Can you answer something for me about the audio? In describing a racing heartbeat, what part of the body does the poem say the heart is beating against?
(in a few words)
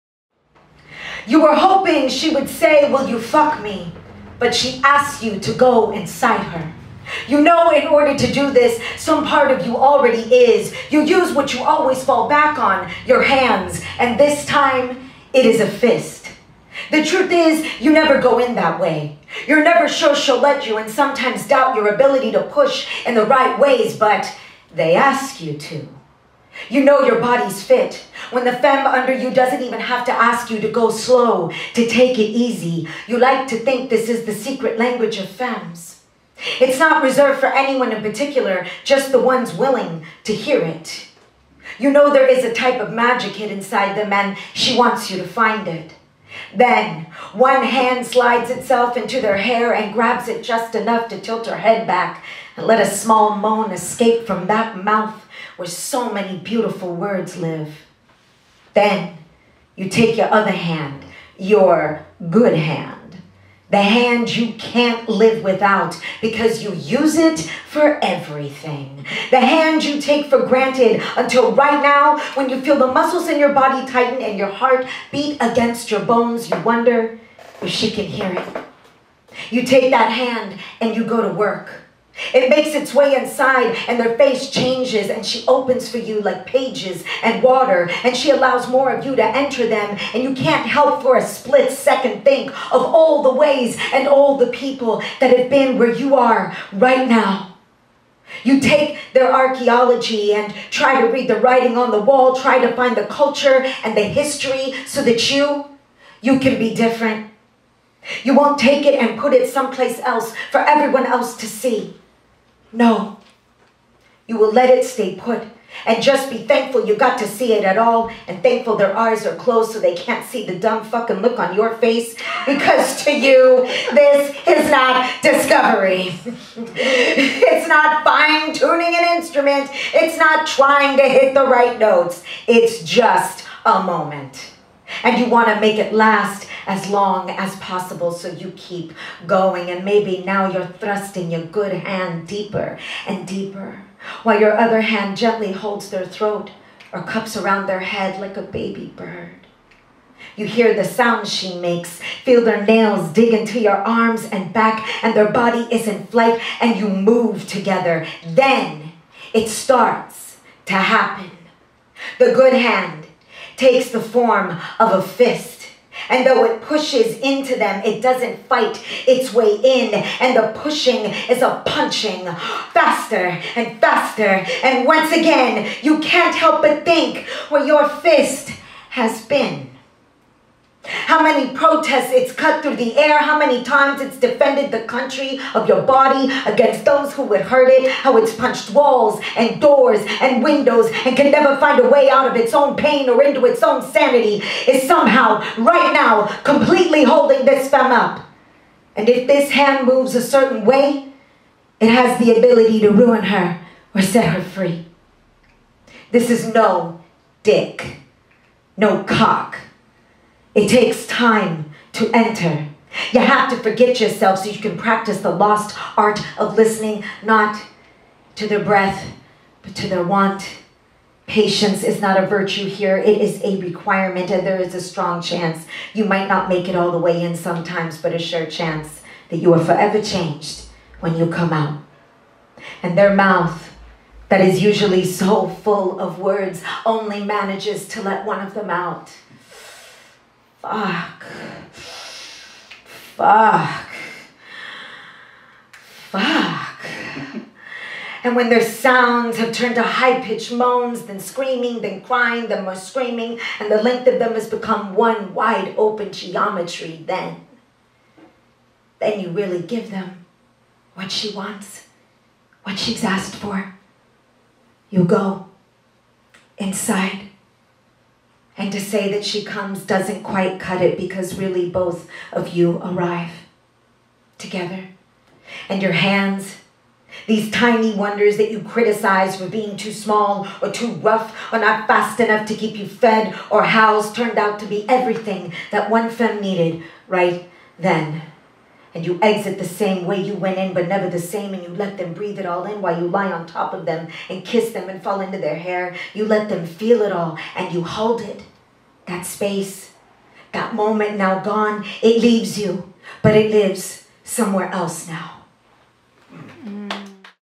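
bones.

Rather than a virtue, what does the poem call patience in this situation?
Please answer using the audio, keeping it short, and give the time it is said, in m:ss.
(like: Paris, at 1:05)
a requirement, at 3:43.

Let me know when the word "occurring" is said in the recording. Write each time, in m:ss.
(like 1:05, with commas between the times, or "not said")
not said.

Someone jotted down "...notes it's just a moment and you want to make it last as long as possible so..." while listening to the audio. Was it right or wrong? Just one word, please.
right.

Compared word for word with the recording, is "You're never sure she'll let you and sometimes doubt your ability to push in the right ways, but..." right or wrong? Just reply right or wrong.
right.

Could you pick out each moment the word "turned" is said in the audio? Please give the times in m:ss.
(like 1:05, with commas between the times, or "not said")
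4:09, 4:44.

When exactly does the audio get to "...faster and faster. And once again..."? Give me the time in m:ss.
2:52.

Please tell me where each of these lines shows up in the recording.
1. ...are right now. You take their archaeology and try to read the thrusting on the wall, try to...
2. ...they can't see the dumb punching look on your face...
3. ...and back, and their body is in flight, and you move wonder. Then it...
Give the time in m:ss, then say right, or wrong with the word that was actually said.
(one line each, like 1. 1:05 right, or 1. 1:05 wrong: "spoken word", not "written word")
1. 1:36 wrong: "writing", not "thrusting"
2. 1:59 wrong: "fucking", not "punching"
3. 2:34 wrong: "together", not "wonder".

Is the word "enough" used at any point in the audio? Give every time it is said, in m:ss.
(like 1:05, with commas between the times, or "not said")
0:50, 4:42.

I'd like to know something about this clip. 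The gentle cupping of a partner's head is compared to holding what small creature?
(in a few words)
a baby bird.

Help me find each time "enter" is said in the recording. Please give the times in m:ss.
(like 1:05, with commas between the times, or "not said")
1:29, 3:32.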